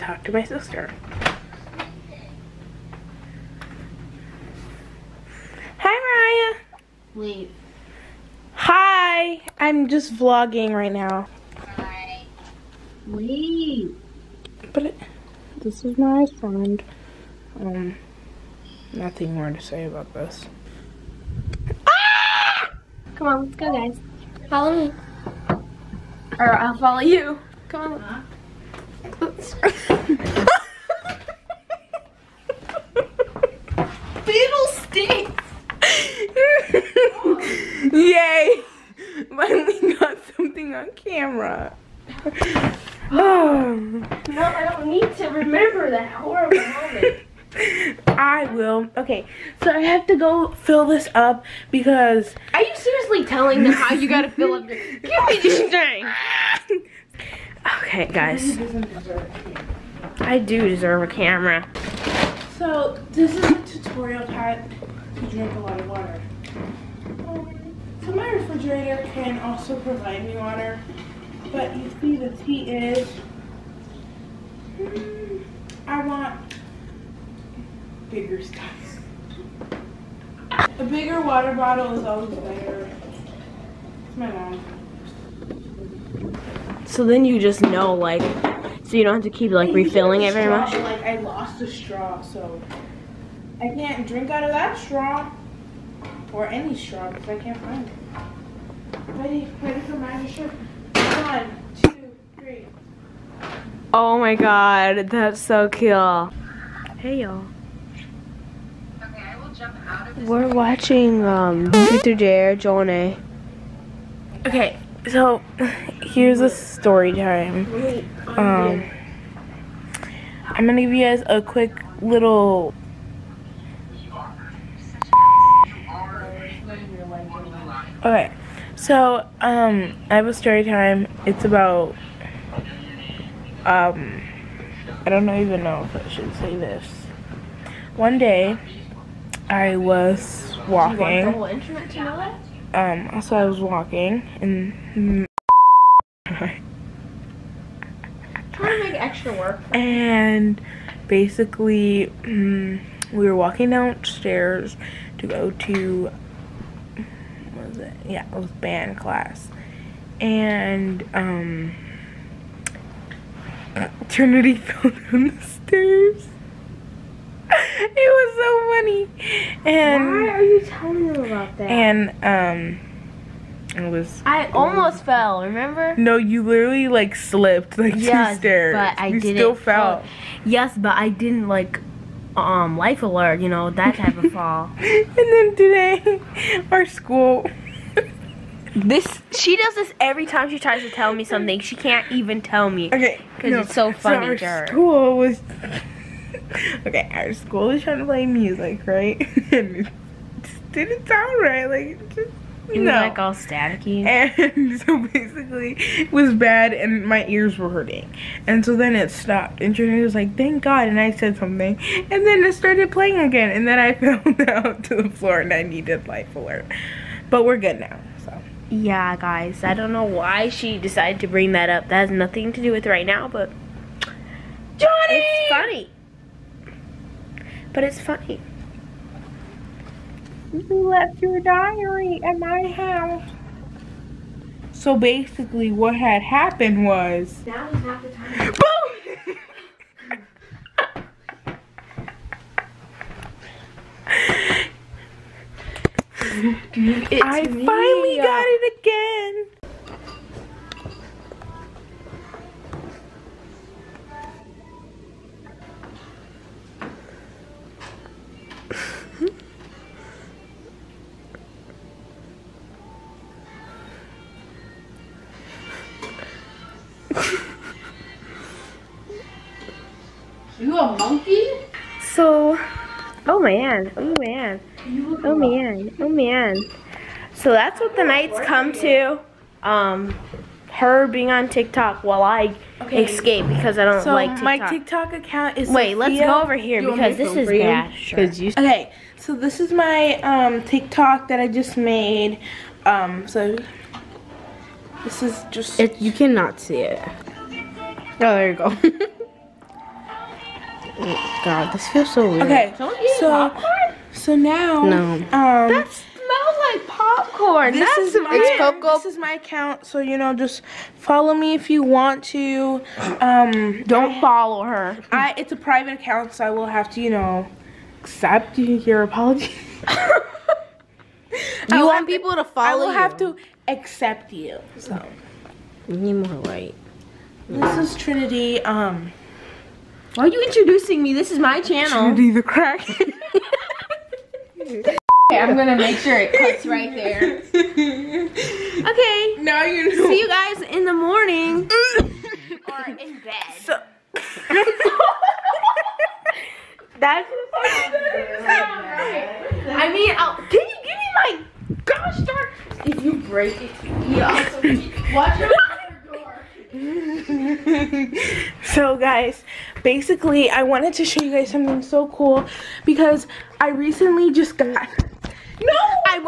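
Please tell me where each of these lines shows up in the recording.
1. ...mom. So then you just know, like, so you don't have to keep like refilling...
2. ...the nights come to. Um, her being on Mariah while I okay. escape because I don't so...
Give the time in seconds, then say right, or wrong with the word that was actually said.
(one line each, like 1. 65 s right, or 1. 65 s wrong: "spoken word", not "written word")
1. 84 s right
2. 277 s wrong: "TikTok", not "Mariah".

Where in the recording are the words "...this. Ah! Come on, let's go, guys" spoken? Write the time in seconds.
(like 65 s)
20 s.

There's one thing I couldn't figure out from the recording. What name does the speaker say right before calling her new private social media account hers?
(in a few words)
Cocoa.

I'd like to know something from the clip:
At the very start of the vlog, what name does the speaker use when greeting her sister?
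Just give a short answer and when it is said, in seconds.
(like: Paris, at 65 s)
Mariah, at 7 s.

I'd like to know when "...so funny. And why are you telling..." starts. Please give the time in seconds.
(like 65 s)
168 s.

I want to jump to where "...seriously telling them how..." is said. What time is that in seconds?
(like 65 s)
52 s.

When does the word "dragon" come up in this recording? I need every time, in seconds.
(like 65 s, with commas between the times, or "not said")
not said.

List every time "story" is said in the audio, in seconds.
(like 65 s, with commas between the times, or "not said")
116 s, 130 s.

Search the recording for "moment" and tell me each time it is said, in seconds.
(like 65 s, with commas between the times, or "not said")
46 s.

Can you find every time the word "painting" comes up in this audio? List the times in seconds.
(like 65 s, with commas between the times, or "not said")
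not said.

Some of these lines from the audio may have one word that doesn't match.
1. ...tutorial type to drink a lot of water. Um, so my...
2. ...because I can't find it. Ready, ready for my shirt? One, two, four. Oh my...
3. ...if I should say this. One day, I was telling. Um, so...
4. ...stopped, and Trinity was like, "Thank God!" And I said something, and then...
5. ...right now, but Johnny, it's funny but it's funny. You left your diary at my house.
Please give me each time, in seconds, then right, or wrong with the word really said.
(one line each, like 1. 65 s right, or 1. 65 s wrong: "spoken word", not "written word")
1. 63 s right
2. 97 s wrong: "three", not "four"
3. 135 s wrong: "walking", not "telling"
4. 209 s right
5. 222 s right.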